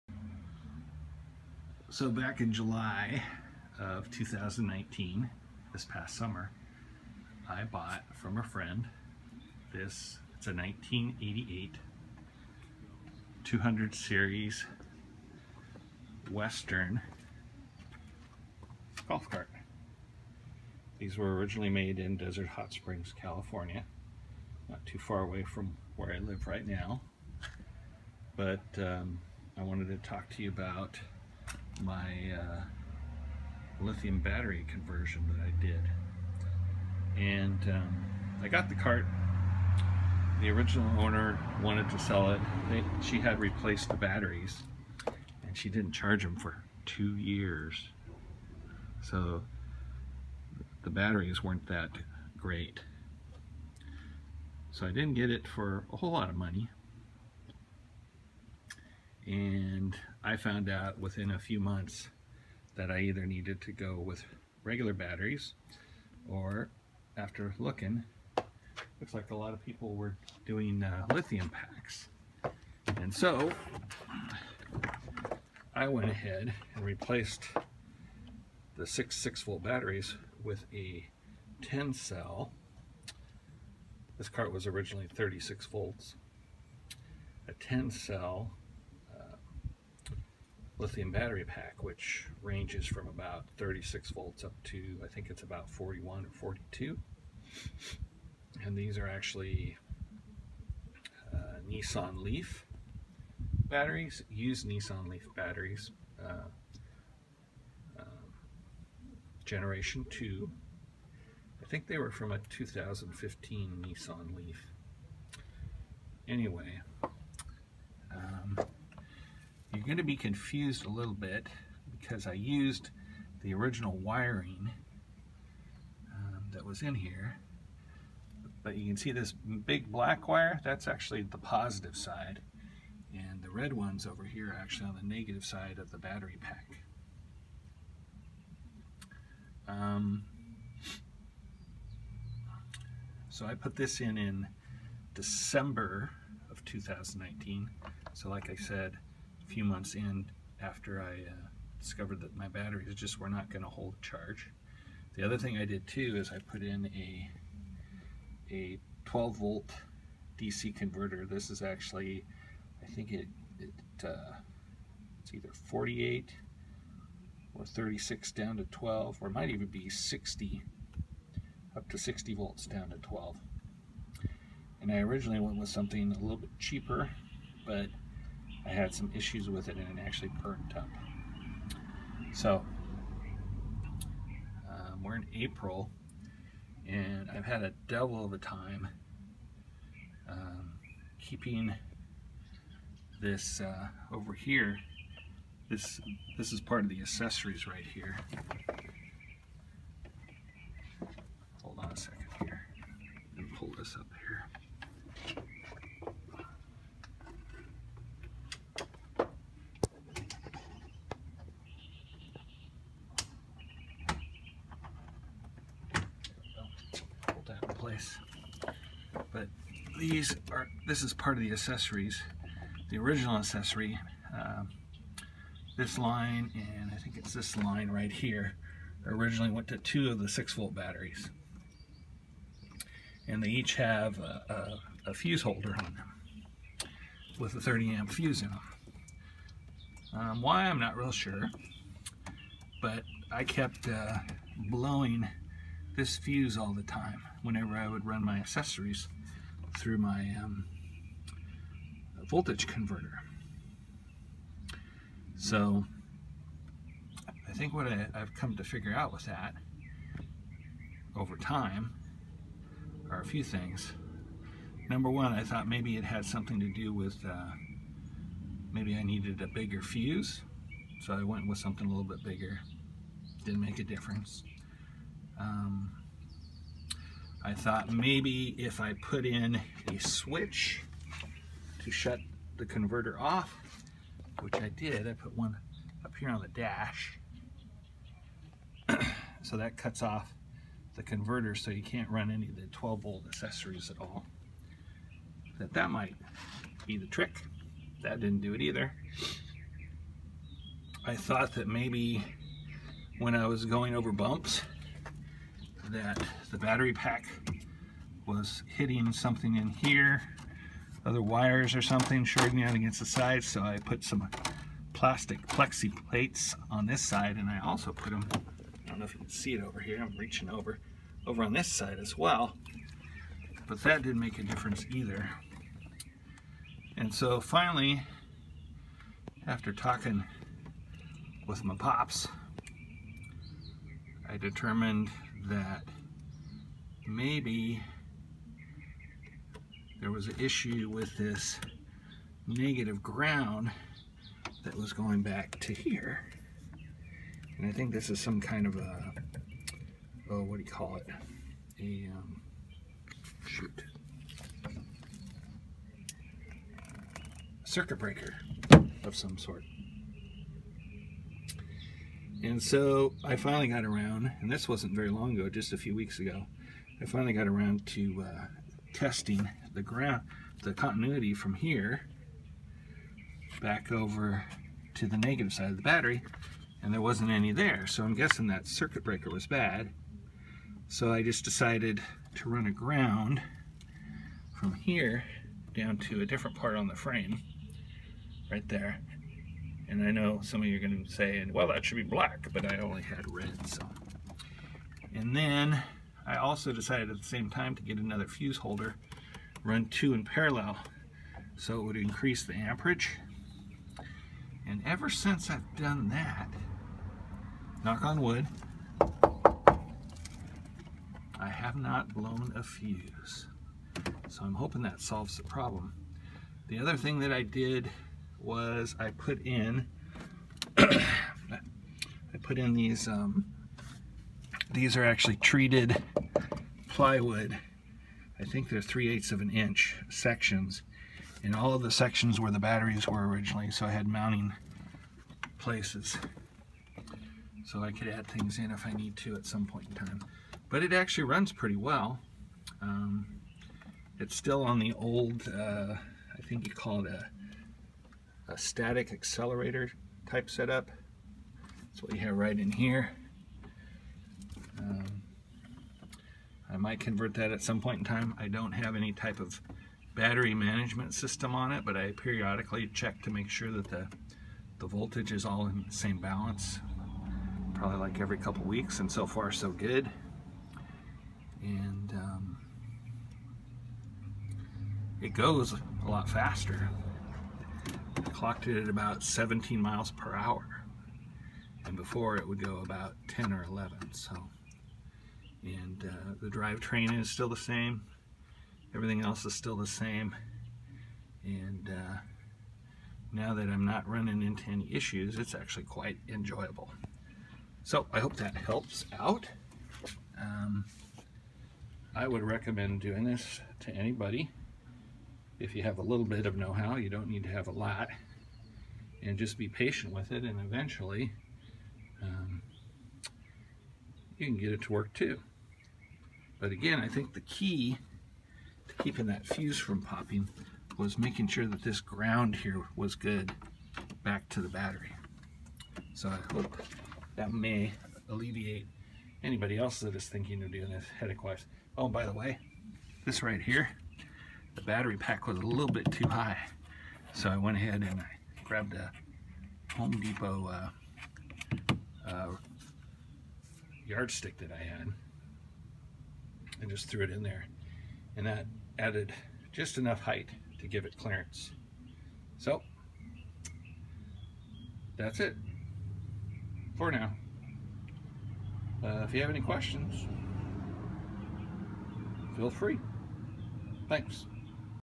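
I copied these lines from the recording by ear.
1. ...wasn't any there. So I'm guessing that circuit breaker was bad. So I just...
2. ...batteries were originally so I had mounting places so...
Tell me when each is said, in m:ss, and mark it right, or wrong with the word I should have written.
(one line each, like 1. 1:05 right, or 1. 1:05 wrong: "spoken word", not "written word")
1. 6:17 right
2. 7:12 right.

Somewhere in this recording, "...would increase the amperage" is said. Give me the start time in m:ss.
6:41.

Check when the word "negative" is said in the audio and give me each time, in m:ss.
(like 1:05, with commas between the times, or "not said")
2:15, 5:42, 6:15.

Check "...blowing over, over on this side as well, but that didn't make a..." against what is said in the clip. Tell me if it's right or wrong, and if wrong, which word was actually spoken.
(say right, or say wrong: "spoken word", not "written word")
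wrong: "reaching", not "blowing".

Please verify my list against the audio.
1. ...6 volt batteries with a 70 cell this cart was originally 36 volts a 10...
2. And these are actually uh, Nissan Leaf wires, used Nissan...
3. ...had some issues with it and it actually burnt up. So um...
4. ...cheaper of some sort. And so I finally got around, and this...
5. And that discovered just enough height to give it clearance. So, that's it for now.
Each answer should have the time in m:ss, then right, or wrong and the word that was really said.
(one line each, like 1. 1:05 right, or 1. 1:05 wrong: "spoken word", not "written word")
1. 1:19 wrong: "10", not "70"
2. 1:38 wrong: "batteries", not "wires"
3. 2:58 right
4. 5:57 wrong: "breaker", not "cheaper"
5. 9:08 wrong: "added", not "discovered".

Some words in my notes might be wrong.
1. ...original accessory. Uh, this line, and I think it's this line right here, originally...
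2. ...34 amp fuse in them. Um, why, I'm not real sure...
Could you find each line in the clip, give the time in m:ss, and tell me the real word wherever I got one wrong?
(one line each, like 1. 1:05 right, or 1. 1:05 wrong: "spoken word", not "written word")
1. 3:42 right
2. 3:57 wrong: "30", not "34".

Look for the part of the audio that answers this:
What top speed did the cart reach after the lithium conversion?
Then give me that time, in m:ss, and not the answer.
7:59.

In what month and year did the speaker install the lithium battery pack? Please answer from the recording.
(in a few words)
December 2019.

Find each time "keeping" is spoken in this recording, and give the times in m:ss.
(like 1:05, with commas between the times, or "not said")
3:11, 8:39.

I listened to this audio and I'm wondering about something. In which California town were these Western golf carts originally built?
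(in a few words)
Desert Hot Springs.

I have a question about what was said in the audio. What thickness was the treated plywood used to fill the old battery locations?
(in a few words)
3/8 inch.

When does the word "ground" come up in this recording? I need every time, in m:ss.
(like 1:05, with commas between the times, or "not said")
5:43, 6:09, 6:22, 8:42.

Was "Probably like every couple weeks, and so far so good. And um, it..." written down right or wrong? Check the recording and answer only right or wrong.
right.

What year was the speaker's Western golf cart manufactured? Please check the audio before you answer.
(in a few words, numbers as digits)
1988.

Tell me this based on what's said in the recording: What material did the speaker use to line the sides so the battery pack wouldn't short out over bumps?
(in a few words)
plexi plates.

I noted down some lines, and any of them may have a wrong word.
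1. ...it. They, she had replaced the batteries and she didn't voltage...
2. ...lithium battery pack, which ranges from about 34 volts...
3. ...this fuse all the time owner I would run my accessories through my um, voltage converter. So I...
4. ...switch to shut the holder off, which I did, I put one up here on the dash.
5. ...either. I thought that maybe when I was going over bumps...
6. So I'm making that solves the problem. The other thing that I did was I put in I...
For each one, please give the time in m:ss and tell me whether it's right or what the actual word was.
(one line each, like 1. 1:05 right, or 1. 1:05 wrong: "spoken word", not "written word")
1. 0:42 wrong: "charge", not "voltage"
2. 1:30 wrong: "36", not "34"
3. 4:05 wrong: "whenever", not "owner"
4. 4:39 wrong: "converter", not "holder"
5. 4:58 right
6. 6:54 wrong: "hoping", not "making".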